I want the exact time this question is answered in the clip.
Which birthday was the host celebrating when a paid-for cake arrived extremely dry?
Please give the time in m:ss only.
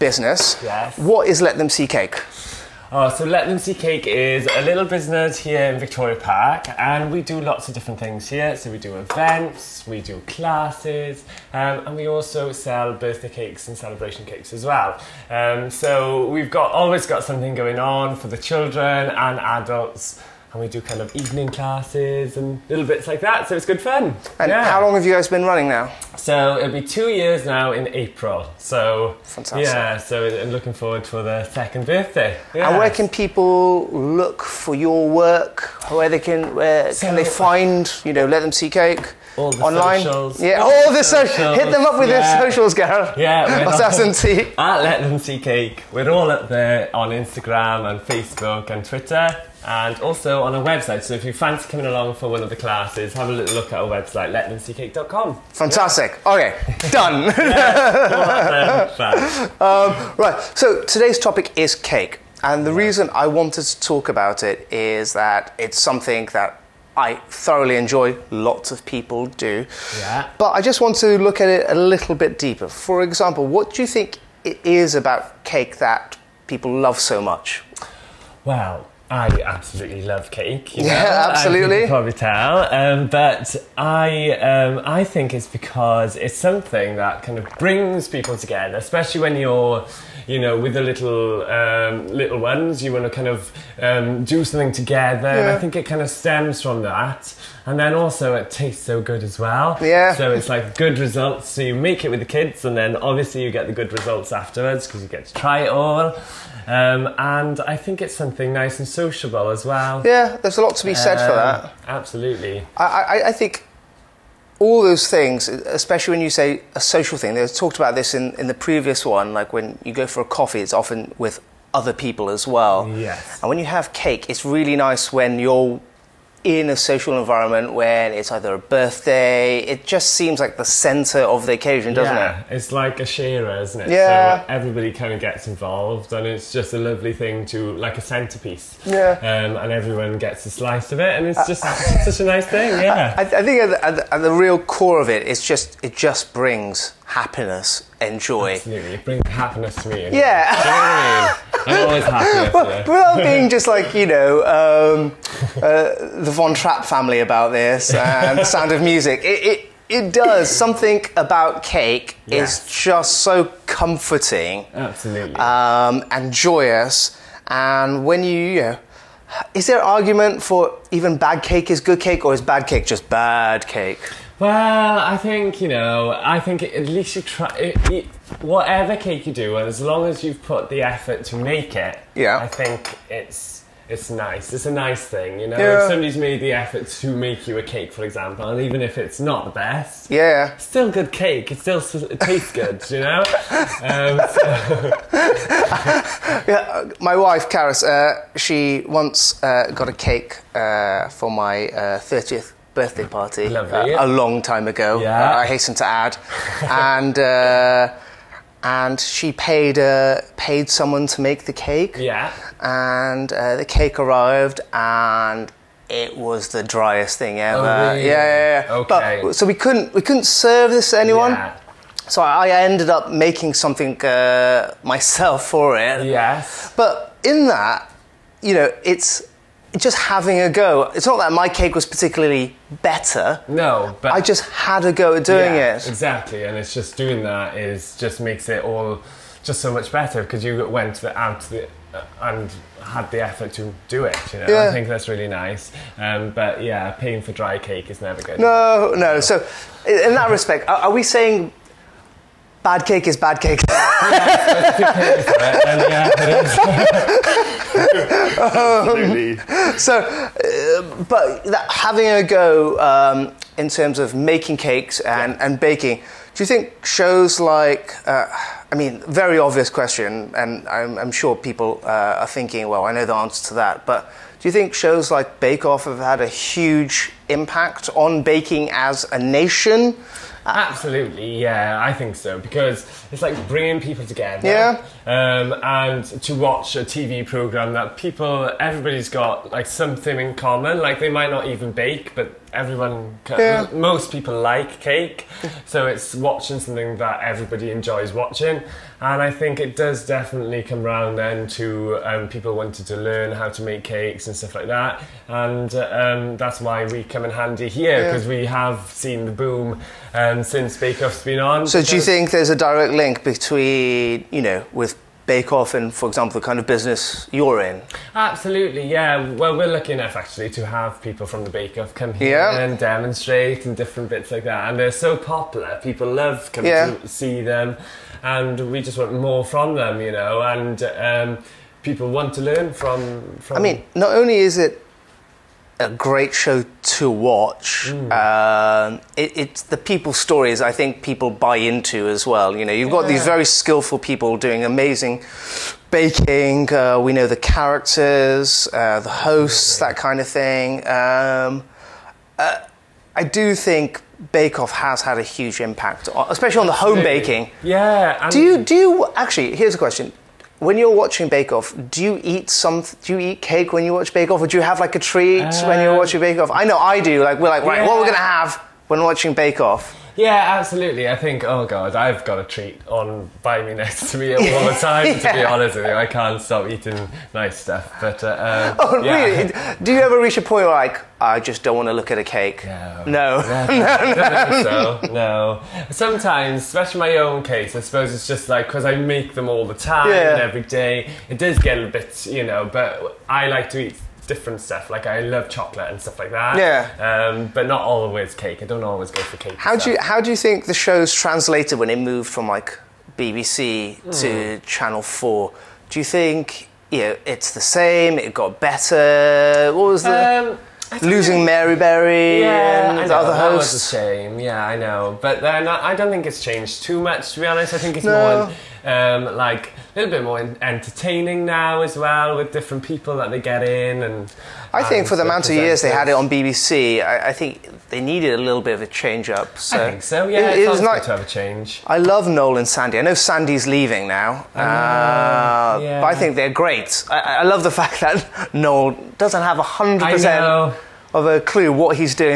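3:21.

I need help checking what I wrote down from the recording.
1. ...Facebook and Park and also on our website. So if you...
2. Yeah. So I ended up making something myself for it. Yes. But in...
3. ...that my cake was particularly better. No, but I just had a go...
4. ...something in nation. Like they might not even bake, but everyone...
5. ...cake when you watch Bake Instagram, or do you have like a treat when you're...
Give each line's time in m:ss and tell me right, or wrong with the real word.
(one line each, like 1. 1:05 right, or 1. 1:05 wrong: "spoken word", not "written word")
1. 0:48 wrong: "Twitter", not "Park"
2. 3:41 right
3. 3:51 right
4. 4:49 wrong: "common", not "nation"
5. 6:03 wrong: "Off", not "Instagram".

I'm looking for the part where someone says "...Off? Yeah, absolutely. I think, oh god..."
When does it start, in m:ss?
6:09.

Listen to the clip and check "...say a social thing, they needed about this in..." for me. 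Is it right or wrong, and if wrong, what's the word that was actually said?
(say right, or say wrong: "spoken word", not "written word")
wrong: "talked", not "needed".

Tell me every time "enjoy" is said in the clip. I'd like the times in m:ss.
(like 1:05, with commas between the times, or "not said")
1:07, 4:57.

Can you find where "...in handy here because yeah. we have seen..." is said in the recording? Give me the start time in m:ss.
5:07.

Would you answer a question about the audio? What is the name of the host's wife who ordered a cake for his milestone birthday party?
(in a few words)
Karis.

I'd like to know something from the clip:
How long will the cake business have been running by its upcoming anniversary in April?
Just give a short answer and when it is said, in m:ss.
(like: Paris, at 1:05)
2 years, at 0:26.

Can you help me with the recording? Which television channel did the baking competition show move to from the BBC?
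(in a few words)
Channel Four.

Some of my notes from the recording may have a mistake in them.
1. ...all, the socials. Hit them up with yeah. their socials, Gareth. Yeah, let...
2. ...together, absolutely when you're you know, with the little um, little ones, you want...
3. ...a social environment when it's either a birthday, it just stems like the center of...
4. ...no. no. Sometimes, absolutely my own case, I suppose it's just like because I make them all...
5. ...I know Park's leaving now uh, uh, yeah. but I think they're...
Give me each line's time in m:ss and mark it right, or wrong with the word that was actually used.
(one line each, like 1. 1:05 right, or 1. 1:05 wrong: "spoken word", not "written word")
1. 0:40 right
2. 1:28 wrong: "especially", not "absolutely"
3. 2:06 wrong: "seems", not "stems"
4. 6:25 wrong: "especially", not "absolutely"
5. 7:12 wrong: "Sandy", not "Park".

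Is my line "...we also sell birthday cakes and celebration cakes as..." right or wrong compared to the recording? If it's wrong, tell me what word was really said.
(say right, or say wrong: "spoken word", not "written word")
right.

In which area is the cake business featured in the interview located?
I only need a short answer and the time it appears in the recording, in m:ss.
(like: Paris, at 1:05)
Victoria Park, at 0:05.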